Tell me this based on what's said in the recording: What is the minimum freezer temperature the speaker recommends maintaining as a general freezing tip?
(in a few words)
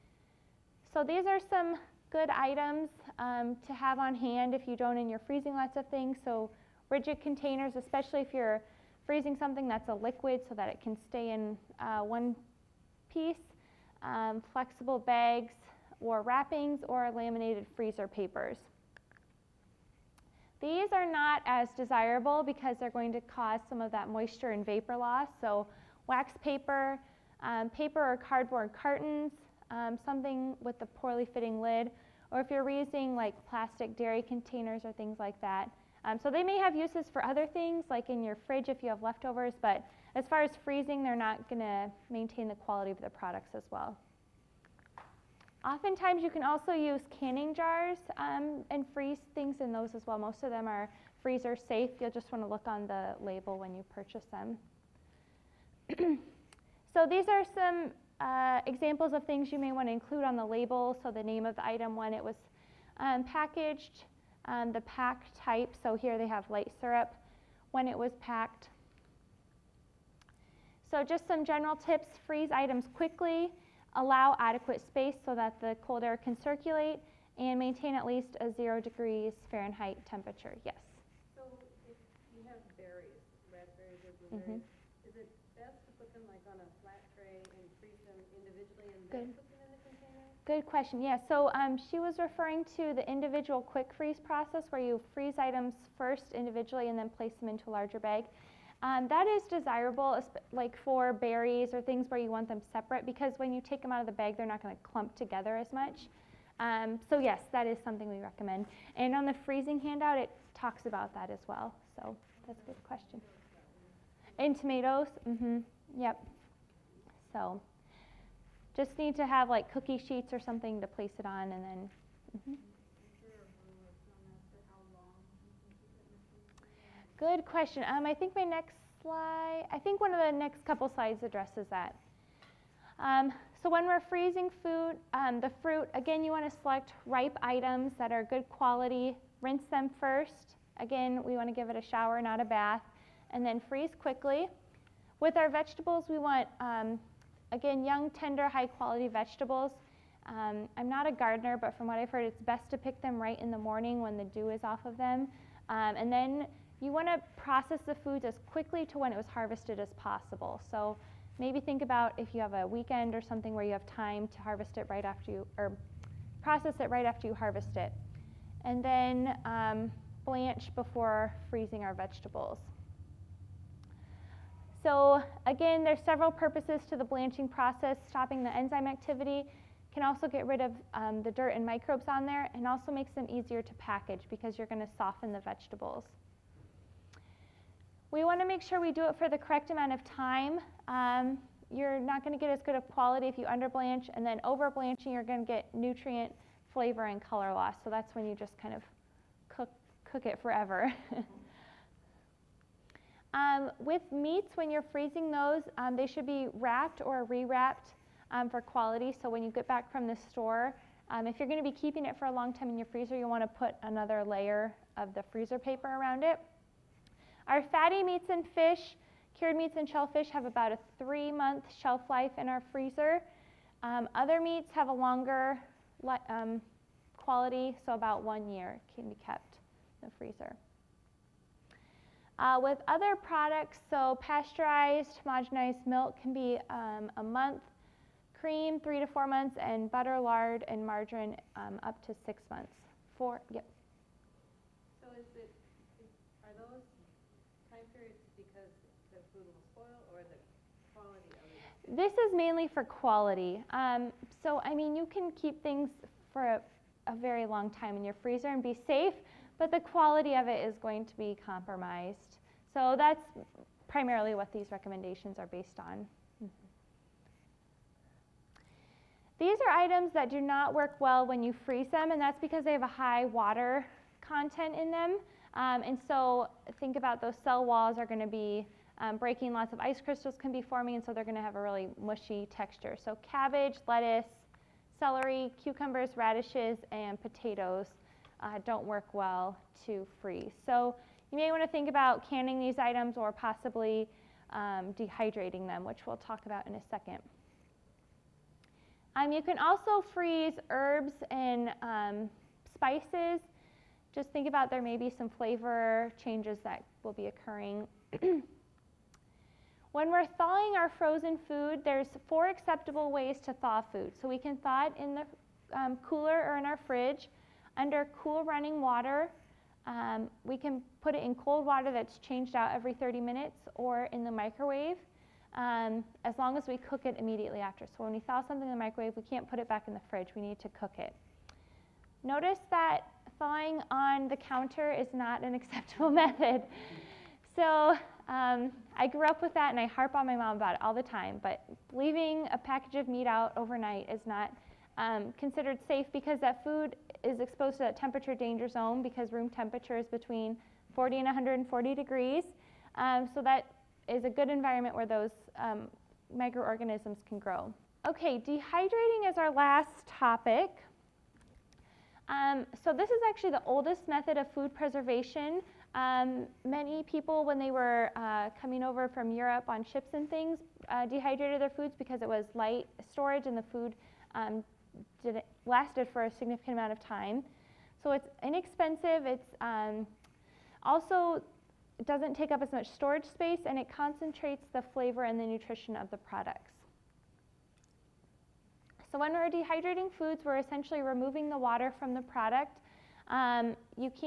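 0 degrees Fahrenheit.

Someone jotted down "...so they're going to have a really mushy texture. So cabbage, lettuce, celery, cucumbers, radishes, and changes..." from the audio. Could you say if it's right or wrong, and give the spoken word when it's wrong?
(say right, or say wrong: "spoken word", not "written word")
wrong: "potatoes", not "changes".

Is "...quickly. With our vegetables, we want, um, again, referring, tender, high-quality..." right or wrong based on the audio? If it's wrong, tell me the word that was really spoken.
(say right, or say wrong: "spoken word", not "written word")
wrong: "young", not "referring".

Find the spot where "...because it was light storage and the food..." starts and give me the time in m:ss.
6:11.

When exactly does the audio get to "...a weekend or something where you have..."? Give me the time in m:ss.
2:42.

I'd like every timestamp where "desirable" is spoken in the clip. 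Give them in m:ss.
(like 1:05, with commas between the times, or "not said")
0:21, 1:39.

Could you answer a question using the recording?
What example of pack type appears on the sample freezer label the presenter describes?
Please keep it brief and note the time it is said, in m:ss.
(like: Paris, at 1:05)
light syrup, at 1:06.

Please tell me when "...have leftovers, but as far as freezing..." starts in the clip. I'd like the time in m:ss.
0:38.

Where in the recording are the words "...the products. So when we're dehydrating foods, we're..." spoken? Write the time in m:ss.
6:26.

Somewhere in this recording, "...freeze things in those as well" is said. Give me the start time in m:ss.
0:48.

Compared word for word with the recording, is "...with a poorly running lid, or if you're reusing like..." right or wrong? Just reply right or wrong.
wrong.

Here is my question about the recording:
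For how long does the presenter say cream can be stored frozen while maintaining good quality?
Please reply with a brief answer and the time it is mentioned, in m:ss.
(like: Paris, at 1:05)
3 to 4 months, at 3:58.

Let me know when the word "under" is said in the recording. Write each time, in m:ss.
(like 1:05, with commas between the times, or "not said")
3:13, 5:17.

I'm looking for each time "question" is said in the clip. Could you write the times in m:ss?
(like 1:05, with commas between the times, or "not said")
1:30, 1:52, 2:07.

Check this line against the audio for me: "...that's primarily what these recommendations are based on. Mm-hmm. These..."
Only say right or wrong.
right.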